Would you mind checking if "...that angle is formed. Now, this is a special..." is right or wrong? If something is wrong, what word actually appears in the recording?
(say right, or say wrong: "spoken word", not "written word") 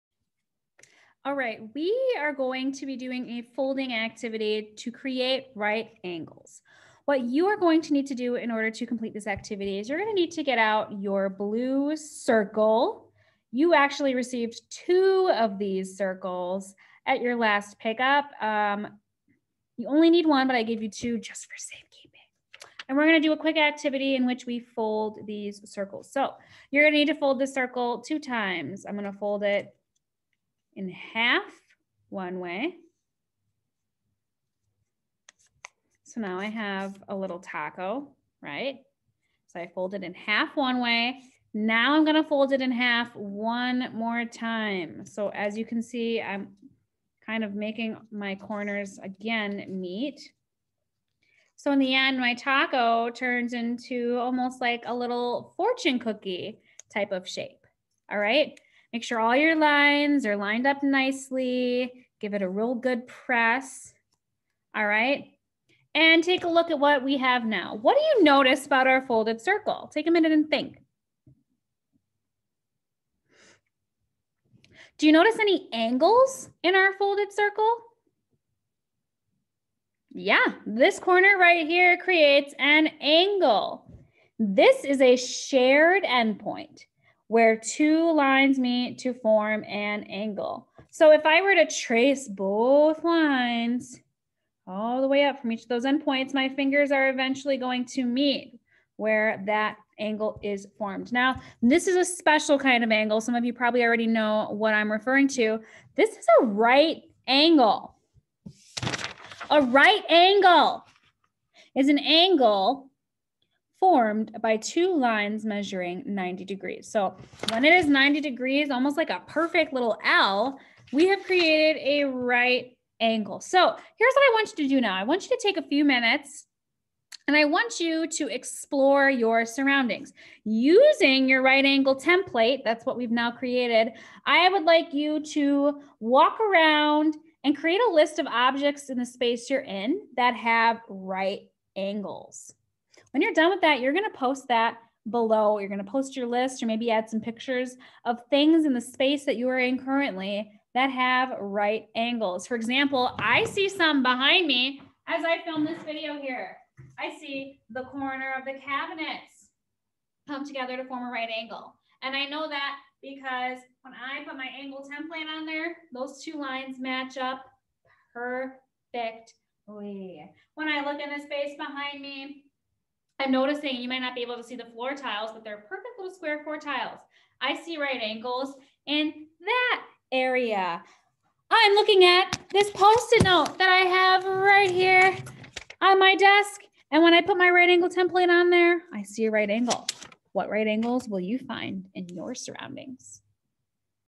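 right.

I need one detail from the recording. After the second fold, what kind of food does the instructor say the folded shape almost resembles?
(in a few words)
Fortune cookie.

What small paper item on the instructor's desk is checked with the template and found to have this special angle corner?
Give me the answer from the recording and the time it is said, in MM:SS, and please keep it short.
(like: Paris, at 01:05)
Post-it note, at 03:02.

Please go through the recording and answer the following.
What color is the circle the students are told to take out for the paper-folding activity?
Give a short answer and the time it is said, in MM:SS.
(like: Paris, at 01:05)
Blue, at 00:11.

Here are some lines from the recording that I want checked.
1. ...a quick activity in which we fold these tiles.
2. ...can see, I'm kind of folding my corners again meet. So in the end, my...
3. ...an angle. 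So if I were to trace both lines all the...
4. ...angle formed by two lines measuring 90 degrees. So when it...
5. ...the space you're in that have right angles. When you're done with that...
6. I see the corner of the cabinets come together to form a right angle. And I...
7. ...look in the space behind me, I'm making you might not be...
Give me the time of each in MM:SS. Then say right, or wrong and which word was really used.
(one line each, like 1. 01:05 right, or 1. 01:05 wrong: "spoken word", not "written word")
1. 00:23 wrong: "circles", not "tiles"
2. 00:45 wrong: "making", not "folding"
3. 01:29 right
4. 01:51 right
5. 02:18 right
6. 02:36 right
7. 02:50 wrong: "noticing", not "making".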